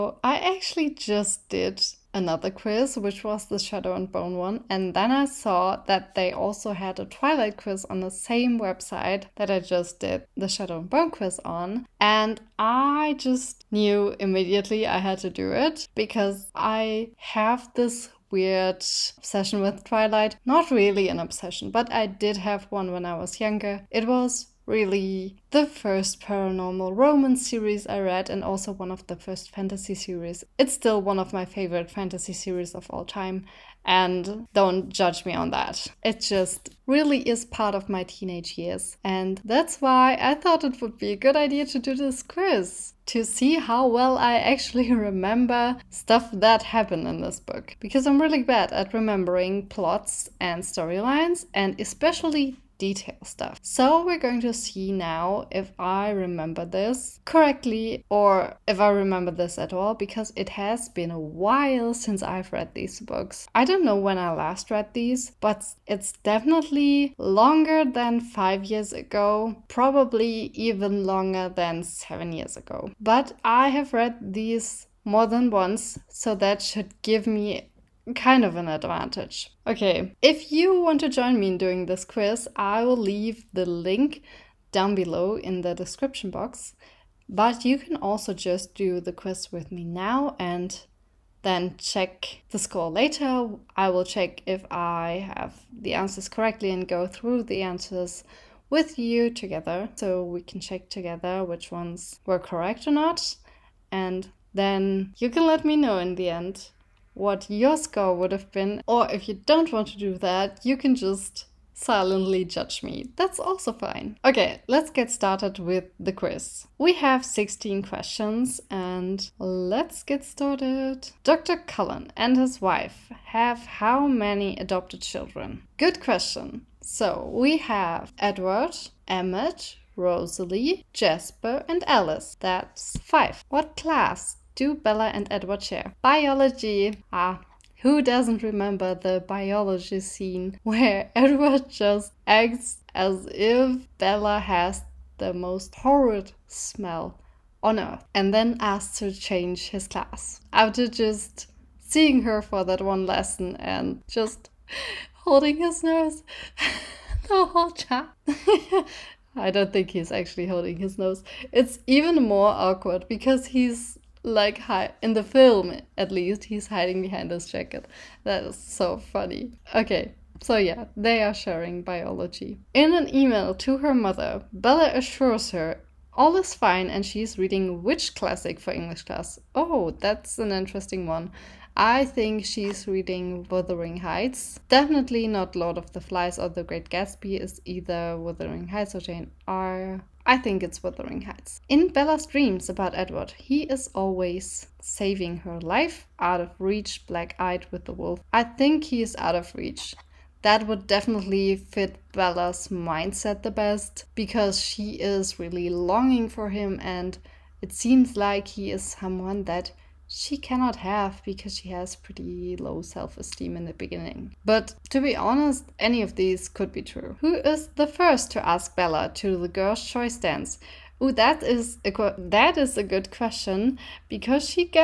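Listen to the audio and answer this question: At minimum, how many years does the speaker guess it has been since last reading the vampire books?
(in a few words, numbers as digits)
7.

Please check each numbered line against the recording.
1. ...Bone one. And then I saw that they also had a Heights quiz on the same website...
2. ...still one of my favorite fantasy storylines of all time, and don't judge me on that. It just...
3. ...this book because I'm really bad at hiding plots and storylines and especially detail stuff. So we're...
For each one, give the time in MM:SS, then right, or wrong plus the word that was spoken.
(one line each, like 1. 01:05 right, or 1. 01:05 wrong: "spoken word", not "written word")
1. 00:04 wrong: "Twilight", not "Heights"
2. 00:30 wrong: "series", not "storylines"
3. 00:47 wrong: "remembering", not "hiding".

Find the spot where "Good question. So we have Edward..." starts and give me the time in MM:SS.
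02:05.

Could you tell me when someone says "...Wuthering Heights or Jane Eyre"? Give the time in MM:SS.
03:08.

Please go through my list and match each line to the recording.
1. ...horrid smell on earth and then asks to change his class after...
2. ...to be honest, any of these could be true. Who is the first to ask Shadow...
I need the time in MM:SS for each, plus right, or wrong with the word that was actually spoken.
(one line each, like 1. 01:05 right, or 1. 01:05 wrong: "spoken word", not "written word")
1. 02:25 right
2. 03:34 wrong: "Bella", not "Shadow".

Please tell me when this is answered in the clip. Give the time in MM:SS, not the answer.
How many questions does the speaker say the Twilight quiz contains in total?
01:57.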